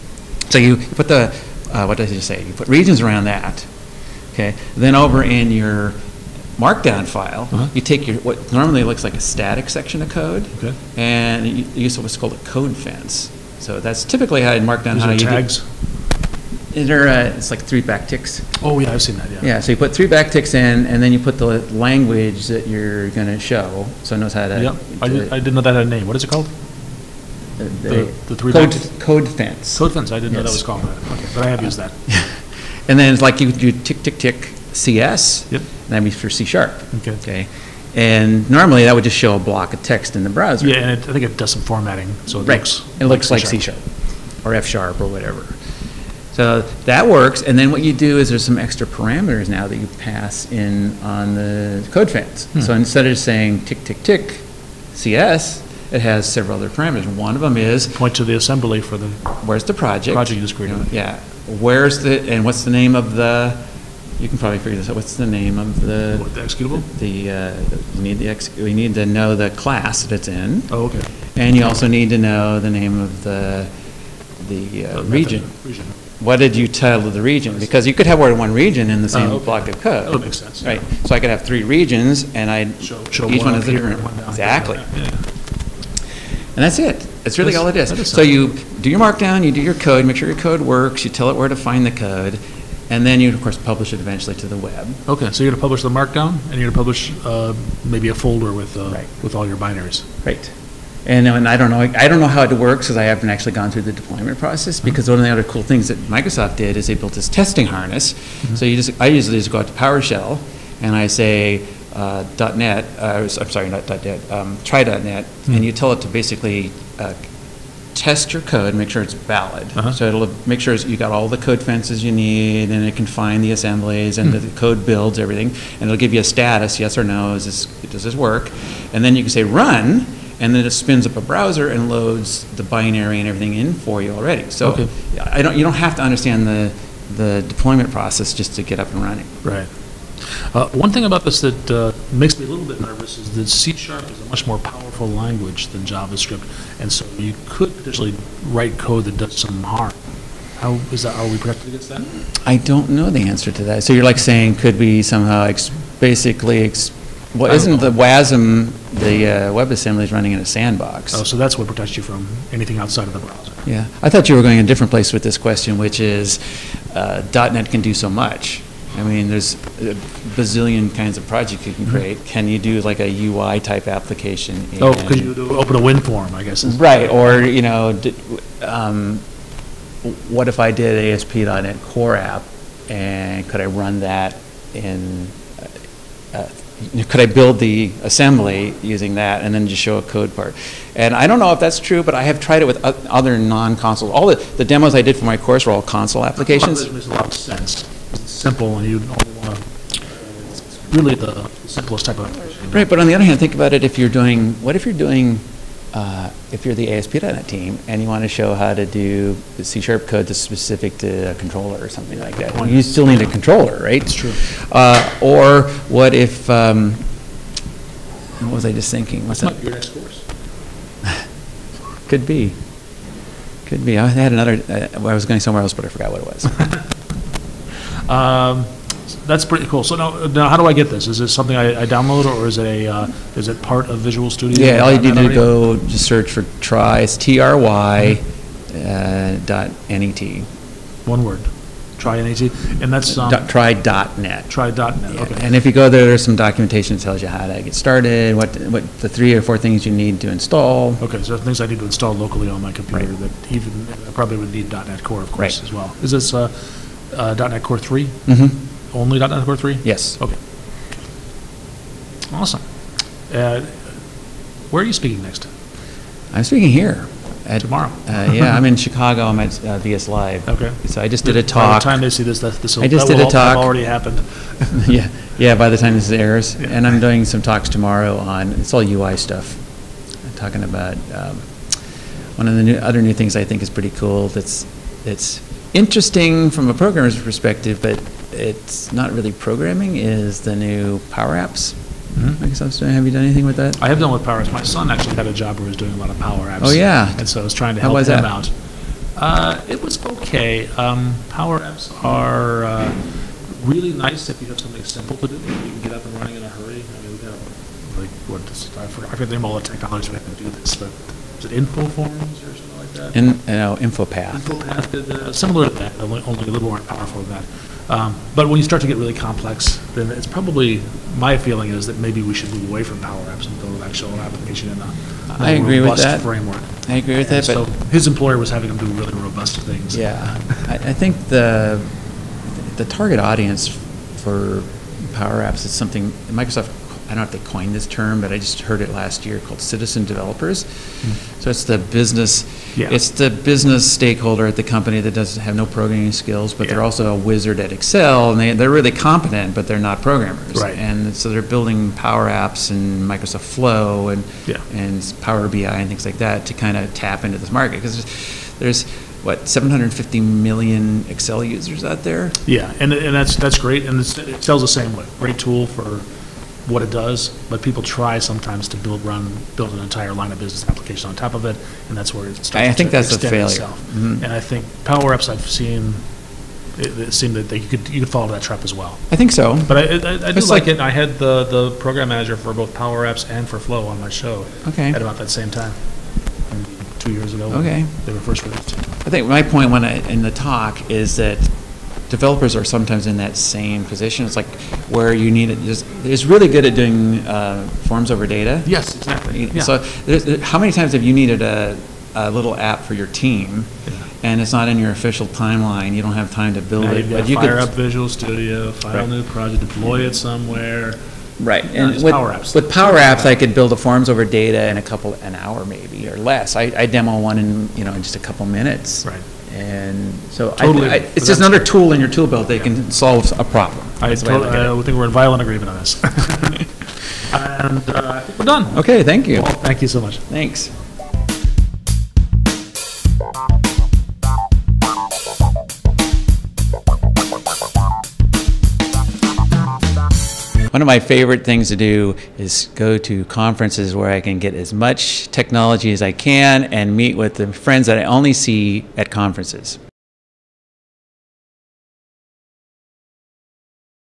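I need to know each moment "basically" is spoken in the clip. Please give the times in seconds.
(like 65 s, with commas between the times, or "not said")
116 s, 156 s.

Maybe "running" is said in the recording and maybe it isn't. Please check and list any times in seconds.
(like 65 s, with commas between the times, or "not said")
139 s, 160 s, 306 s.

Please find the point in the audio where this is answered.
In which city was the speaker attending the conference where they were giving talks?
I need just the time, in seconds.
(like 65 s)
268 s.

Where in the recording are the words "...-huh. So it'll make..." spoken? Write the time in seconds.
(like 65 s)
119 s.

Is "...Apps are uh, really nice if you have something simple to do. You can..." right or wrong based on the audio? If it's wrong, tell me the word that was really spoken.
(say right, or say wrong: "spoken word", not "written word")
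right.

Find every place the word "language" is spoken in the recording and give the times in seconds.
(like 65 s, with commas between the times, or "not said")
21 s, 145 s.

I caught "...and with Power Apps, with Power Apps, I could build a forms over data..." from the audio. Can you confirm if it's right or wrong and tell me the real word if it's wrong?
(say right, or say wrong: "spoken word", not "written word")
right.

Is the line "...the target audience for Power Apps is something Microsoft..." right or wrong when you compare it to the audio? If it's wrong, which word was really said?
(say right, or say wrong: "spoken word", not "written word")
right.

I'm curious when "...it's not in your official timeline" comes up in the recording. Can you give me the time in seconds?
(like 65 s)
404 s.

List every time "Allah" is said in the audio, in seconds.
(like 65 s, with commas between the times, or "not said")
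not said.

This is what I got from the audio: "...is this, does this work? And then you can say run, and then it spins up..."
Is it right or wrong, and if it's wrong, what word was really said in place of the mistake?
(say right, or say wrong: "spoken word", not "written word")
right.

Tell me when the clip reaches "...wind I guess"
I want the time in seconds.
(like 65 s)
175 s.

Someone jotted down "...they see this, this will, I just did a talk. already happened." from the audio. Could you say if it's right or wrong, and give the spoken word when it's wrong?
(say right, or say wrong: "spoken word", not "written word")
right.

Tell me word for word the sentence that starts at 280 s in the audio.
I'm talking about um, one of the new, other new things I think is pretty cool.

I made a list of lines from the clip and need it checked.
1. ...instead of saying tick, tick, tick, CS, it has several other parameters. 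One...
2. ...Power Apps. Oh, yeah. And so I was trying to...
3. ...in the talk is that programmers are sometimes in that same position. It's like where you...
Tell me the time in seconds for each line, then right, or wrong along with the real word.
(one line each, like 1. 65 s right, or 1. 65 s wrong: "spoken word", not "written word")
1. 52 s right
2. 296 s right
3. 390 s wrong: "developers", not "programmers".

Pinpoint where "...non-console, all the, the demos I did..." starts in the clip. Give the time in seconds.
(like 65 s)
193 s.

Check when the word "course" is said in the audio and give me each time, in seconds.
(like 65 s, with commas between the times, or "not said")
93 s, 195 s, 219 s, 255 s.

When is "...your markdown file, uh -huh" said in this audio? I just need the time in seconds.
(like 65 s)
5 s.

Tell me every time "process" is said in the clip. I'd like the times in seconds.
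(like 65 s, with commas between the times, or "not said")
104 s, 137 s.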